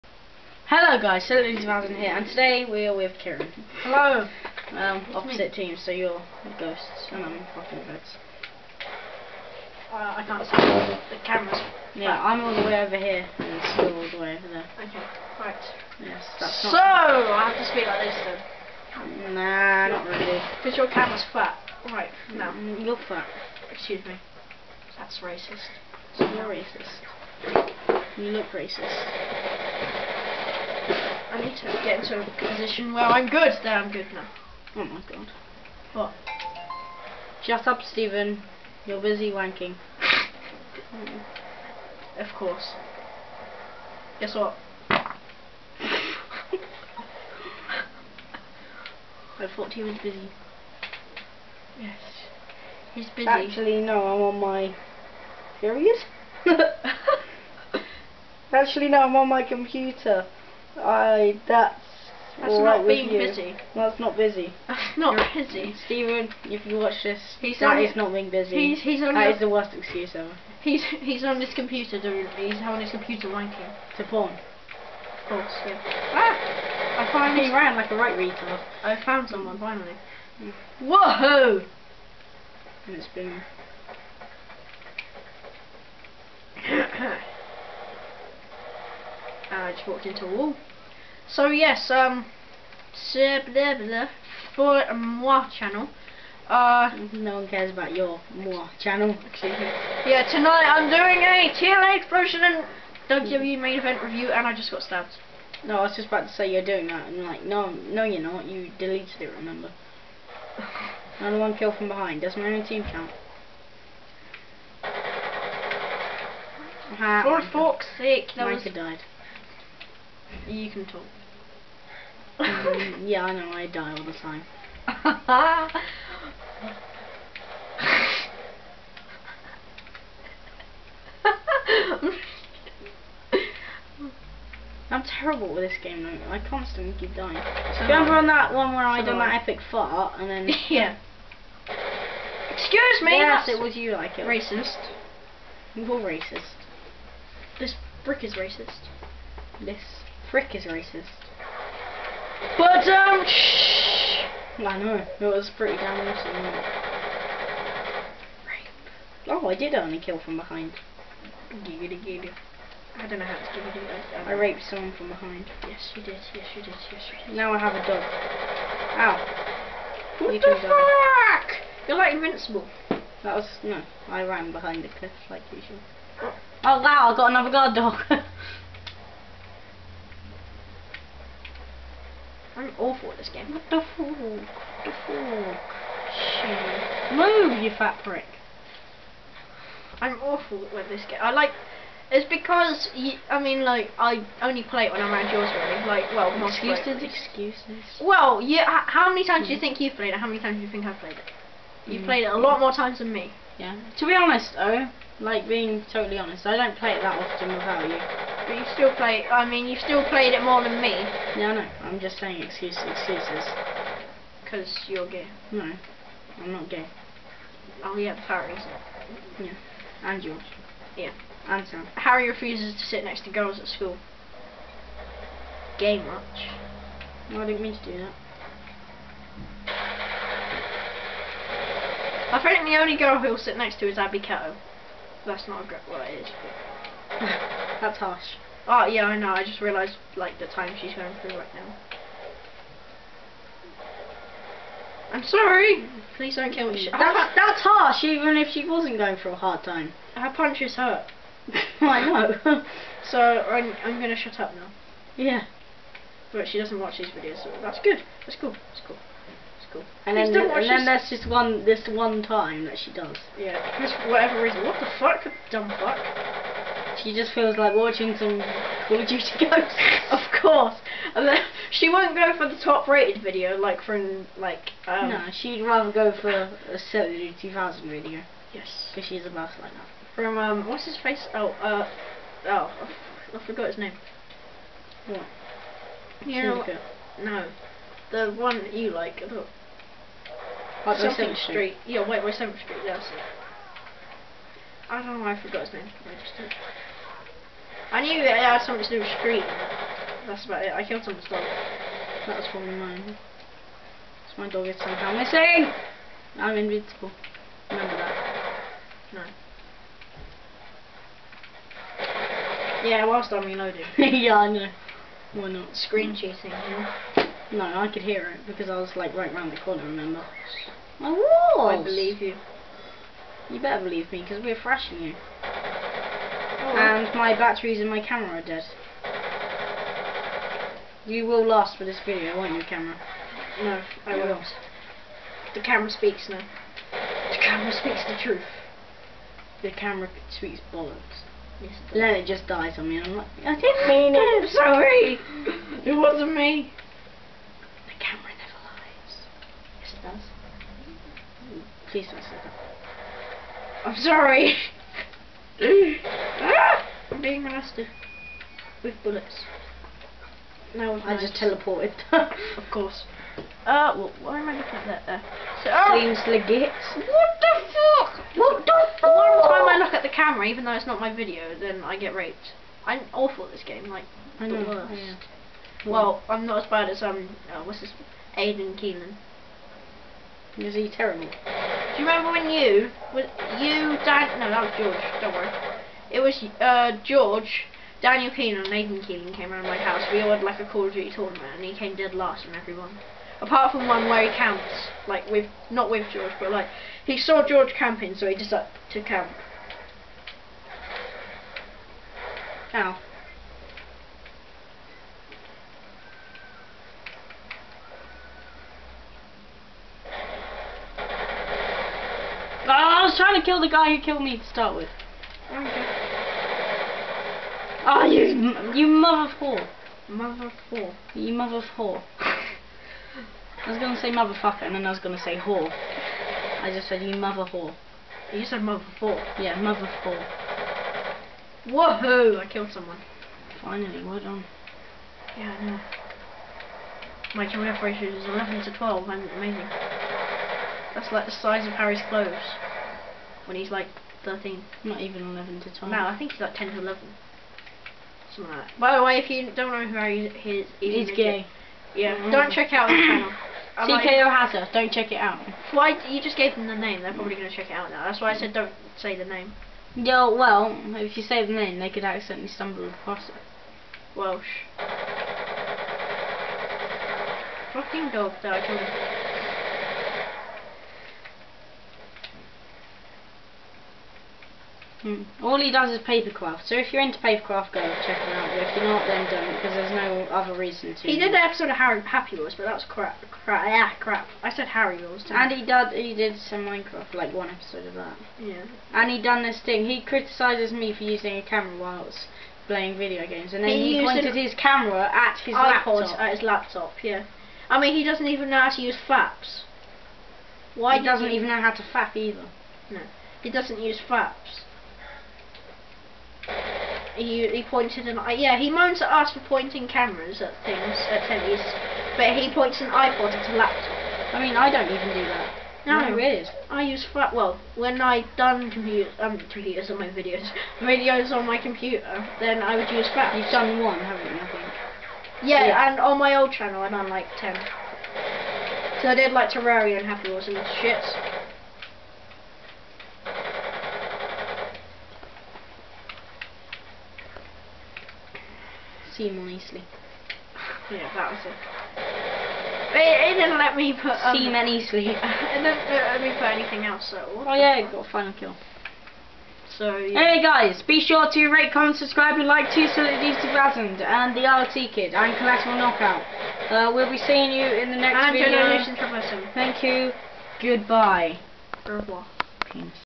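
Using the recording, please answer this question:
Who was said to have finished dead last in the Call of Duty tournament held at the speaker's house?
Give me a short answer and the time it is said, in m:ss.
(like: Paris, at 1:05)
Nathan Keelan, at 6:28.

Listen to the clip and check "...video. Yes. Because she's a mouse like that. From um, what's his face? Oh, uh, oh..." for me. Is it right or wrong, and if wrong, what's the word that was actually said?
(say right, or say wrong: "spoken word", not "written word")
right.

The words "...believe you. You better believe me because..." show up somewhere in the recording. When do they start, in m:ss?
5:21.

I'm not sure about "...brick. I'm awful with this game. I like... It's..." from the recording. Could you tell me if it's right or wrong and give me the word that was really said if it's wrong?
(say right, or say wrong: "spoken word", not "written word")
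wrong: "prick", not "brick".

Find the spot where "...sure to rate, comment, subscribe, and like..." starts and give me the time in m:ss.
9:10.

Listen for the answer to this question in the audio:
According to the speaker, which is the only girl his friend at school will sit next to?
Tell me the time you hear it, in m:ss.
3:53.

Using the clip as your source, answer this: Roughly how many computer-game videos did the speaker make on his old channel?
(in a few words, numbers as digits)
10.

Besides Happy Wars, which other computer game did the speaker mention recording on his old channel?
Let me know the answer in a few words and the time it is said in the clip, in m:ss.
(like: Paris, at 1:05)
Terraria, at 8:49.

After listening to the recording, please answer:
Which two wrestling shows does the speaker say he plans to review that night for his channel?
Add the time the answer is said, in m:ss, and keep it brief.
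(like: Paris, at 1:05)
TNA Xplosion and WWE Main Event, at 1:41.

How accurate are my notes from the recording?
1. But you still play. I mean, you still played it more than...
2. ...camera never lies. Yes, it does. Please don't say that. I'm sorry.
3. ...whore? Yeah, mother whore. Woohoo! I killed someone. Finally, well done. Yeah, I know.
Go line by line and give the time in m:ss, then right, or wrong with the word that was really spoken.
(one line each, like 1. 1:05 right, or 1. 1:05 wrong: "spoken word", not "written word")
1. 3:28 right
2. 5:48 right
3. 7:08 right.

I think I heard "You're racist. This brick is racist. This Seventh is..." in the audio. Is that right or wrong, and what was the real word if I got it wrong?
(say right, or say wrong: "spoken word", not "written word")
wrong: "Frick", not "Seventh".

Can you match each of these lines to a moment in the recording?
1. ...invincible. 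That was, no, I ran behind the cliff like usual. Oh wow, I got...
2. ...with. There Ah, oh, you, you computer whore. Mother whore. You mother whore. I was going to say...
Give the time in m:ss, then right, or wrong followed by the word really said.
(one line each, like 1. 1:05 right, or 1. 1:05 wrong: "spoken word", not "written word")
1. 2:52 right
2. 6:54 wrong: "mother", not "computer".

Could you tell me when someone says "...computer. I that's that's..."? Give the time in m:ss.
0:59.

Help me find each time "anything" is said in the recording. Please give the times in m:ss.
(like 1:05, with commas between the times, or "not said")
9:06.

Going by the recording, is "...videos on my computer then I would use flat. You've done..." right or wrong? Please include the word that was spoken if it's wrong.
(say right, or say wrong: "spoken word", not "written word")
right.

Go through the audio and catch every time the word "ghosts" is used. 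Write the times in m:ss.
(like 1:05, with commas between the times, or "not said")
0:06, 4:29.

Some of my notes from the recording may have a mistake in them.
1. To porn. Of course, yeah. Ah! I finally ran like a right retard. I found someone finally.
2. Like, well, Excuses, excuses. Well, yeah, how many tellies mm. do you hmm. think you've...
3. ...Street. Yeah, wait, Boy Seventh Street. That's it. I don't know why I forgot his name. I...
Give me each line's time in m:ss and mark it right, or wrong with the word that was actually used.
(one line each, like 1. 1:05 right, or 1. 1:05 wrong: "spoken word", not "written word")
1. 1:13 right
2. 3:15 wrong: "times", not "tellies"
3. 4:51 right.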